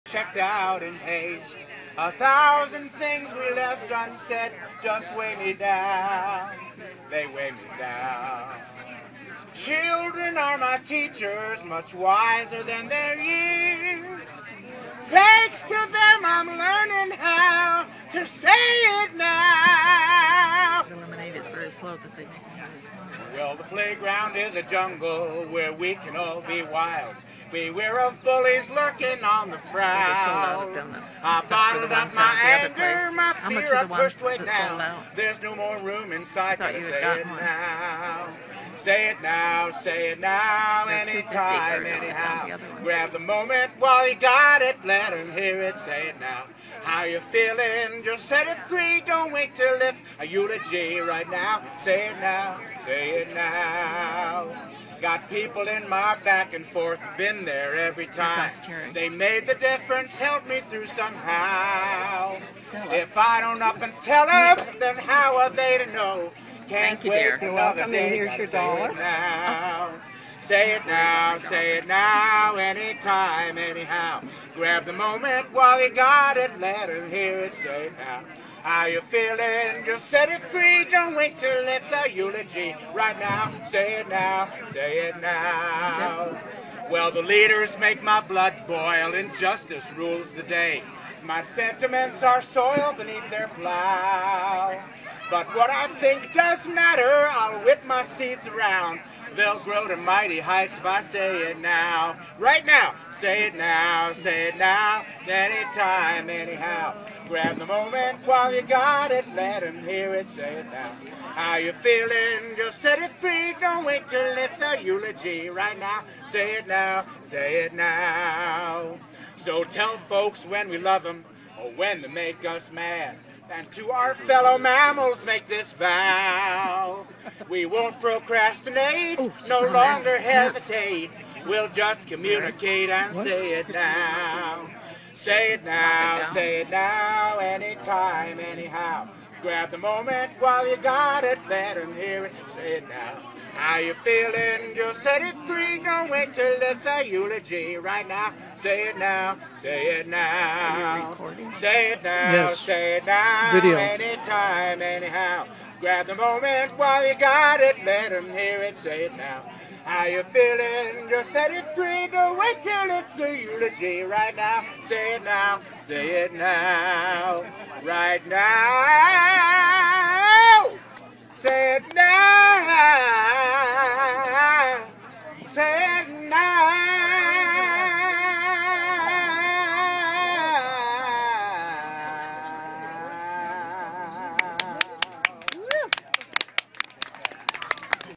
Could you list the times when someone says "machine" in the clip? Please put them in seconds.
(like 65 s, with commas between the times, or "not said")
not said.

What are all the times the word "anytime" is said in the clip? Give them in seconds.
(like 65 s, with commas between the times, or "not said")
40 s, 72 s, 105 s, 137 s, 153 s.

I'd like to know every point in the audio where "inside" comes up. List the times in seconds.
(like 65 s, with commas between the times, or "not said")
36 s.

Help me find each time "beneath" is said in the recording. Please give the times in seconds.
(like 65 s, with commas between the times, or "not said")
92 s.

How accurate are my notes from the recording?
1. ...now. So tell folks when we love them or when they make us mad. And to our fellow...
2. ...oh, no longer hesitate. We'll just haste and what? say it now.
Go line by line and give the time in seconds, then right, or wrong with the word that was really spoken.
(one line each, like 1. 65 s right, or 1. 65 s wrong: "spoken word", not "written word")
1. 117 s right
2. 129 s wrong: "communicate", not "haste".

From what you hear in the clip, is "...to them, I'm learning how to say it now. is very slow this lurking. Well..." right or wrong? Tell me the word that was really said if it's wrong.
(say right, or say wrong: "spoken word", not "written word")
wrong: "evening", not "lurking".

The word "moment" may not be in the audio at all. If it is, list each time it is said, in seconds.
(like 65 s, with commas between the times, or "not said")
43 s, 74 s, 107 s, 139 s, 156 s.